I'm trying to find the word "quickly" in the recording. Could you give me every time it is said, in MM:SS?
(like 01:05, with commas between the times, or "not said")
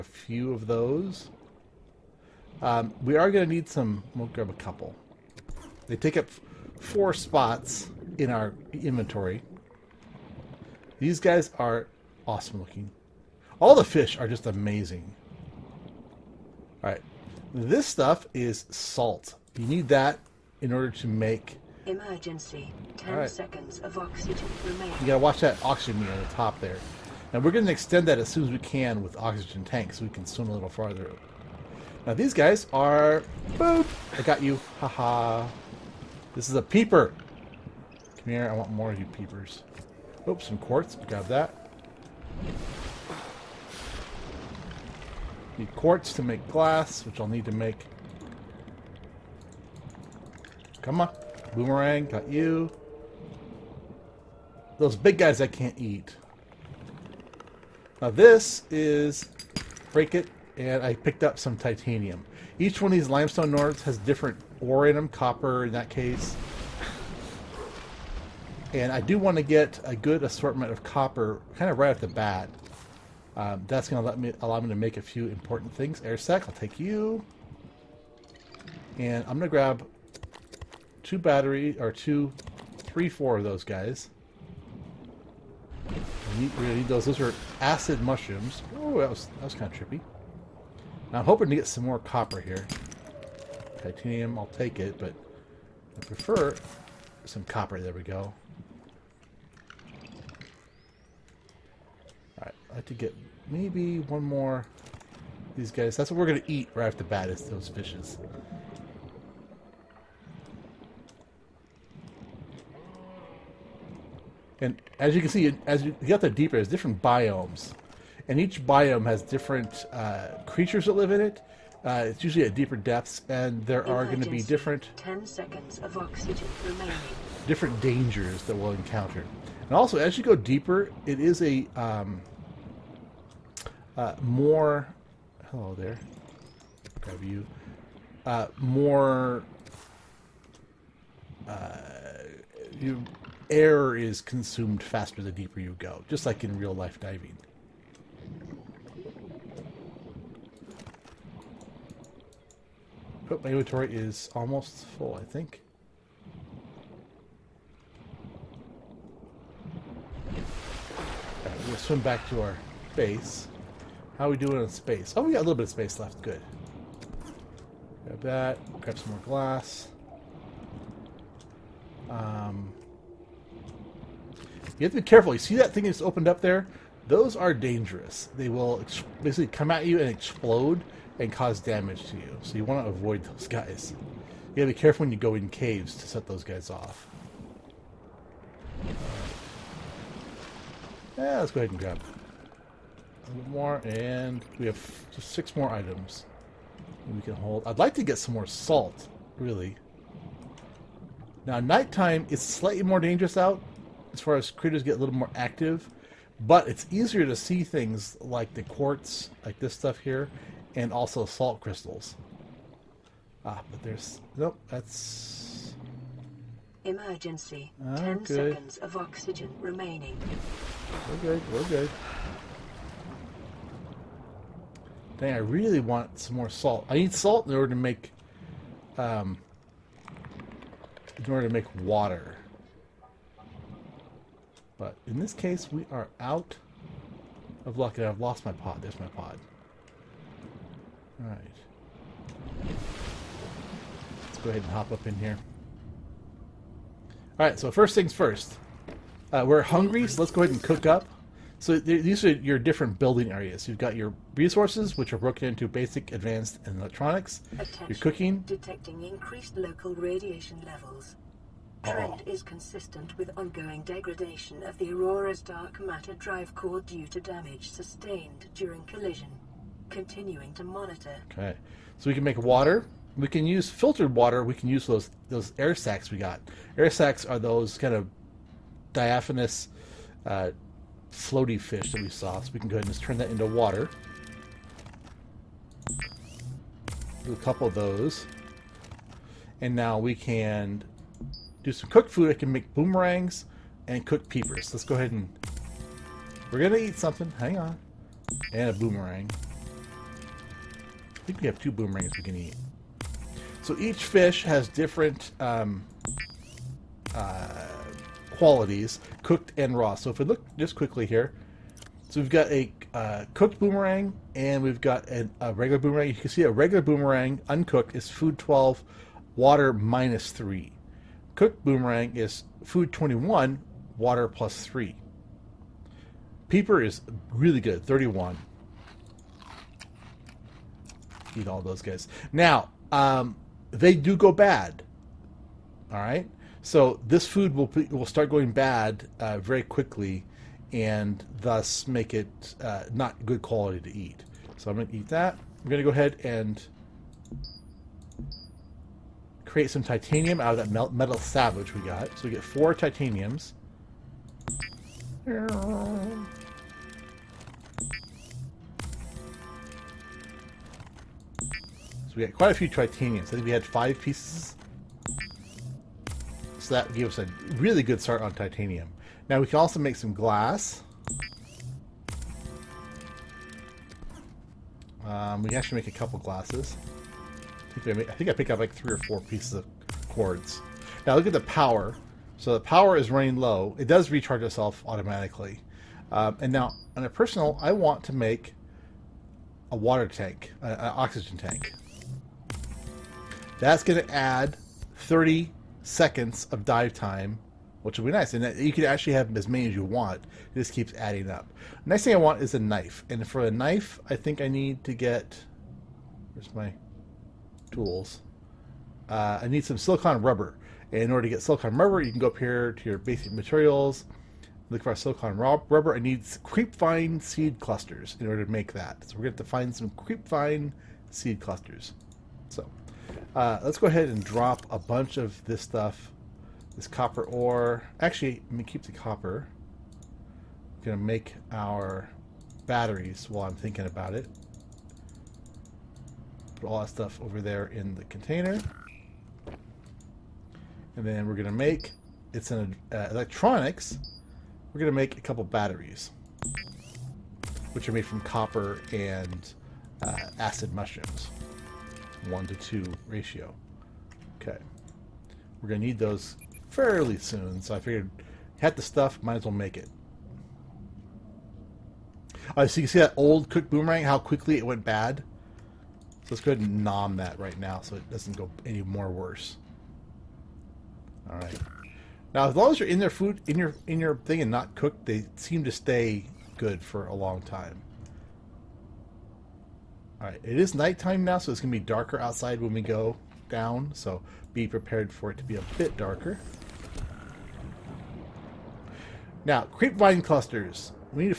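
05:10, 05:39, 07:44.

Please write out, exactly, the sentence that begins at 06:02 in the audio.
So we got quite a few Tritanians.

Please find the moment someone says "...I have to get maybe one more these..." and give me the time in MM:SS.
01:42.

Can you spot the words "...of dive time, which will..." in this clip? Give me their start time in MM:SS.
06:36.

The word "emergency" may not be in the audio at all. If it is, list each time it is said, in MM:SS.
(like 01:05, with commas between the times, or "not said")
00:21, 03:36.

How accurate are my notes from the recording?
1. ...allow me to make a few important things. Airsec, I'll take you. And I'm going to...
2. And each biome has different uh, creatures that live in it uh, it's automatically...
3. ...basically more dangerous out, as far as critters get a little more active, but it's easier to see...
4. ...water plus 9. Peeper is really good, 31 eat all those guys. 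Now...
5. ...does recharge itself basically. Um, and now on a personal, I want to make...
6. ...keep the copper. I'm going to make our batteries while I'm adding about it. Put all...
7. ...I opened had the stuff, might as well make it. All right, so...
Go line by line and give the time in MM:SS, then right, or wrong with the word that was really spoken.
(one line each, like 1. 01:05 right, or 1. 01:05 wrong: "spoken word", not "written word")
1. 01:14 right
2. 01:58 wrong: "usually", not "automatically"
3. 03:22 wrong: "slightly", not "basically"
4. 05:23 wrong: "3", not "9"
5. 06:23 wrong: "automatically", not "basically"
6. 07:08 wrong: "thinking", not "adding"
7. 07:37 wrong: "figured", not "opened".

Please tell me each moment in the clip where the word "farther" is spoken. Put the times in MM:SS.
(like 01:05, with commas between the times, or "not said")
00:30.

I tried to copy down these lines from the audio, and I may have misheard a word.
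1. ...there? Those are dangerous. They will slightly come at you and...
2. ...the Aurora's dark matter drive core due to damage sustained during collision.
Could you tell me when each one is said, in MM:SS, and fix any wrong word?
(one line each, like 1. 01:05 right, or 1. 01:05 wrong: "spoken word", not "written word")
1. 02:56 wrong: "basically", not "slightly"
2. 04:24 right.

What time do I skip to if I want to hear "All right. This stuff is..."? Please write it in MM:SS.
00:16.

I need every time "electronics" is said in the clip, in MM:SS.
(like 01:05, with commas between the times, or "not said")
04:16, 07:23.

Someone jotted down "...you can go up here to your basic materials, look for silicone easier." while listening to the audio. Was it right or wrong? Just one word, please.
wrong.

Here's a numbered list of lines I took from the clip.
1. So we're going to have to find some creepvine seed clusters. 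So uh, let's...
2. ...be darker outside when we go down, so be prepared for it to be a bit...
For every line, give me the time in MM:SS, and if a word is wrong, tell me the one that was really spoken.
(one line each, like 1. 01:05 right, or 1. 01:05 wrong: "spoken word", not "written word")
1. 06:59 right
2. 08:01 right.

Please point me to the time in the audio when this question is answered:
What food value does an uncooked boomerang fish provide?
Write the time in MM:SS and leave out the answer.
05:18.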